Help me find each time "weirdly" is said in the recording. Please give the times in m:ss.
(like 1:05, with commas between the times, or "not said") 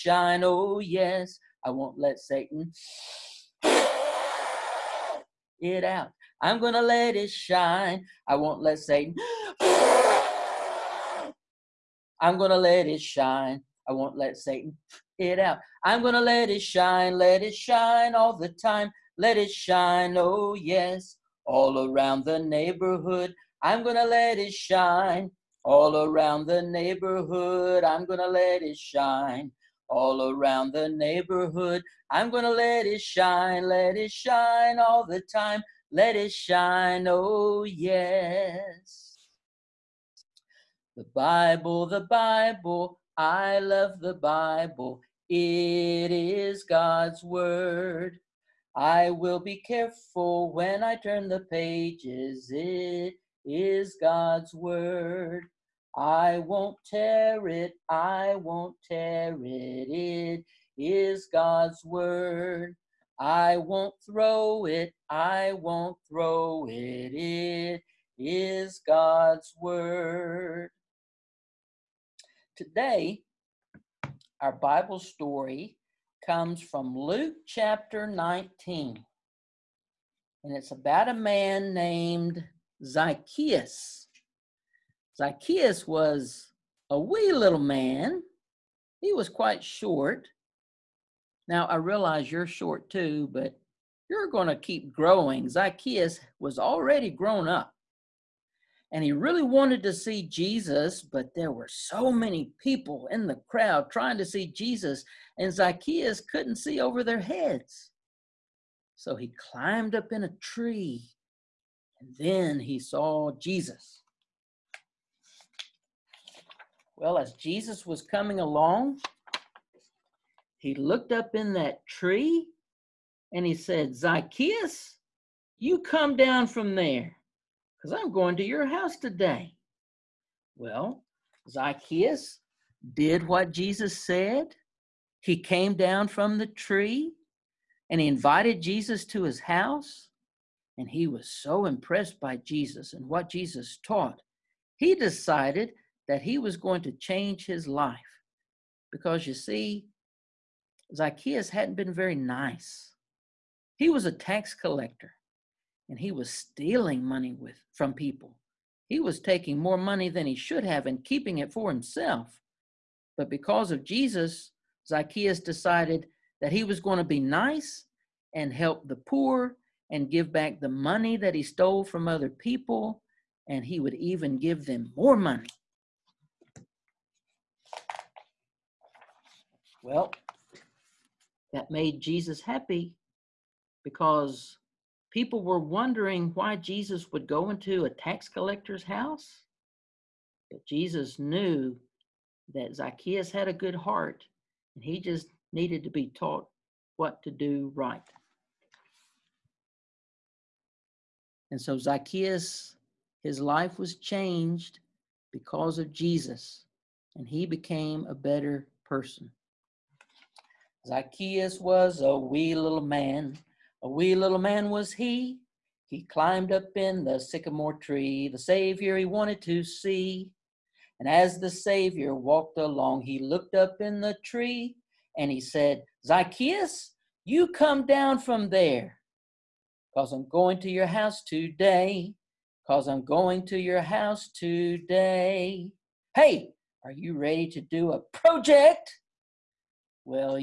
not said.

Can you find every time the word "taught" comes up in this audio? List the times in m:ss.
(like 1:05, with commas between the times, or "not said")
2:23, 3:16.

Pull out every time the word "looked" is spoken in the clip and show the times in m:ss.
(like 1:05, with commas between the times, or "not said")
2:00, 3:43.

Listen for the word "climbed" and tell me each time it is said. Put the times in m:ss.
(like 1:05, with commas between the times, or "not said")
1:49, 3:36.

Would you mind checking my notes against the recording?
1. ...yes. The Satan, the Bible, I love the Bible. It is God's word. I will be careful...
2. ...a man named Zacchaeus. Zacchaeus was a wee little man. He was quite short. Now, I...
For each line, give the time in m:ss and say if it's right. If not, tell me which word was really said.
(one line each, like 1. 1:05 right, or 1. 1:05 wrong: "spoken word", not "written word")
1. 0:37 wrong: "Bible", not "Satan"
2. 1:21 right.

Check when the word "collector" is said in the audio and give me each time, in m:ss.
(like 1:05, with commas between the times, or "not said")
2:34, 3:08.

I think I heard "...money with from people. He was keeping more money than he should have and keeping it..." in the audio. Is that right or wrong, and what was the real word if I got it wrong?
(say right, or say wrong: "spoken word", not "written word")
wrong: "taking", not "keeping".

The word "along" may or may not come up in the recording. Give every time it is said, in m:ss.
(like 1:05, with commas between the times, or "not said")
1:58, 3:42.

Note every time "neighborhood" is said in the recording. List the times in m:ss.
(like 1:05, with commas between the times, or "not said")
0:22, 0:26, 0:30.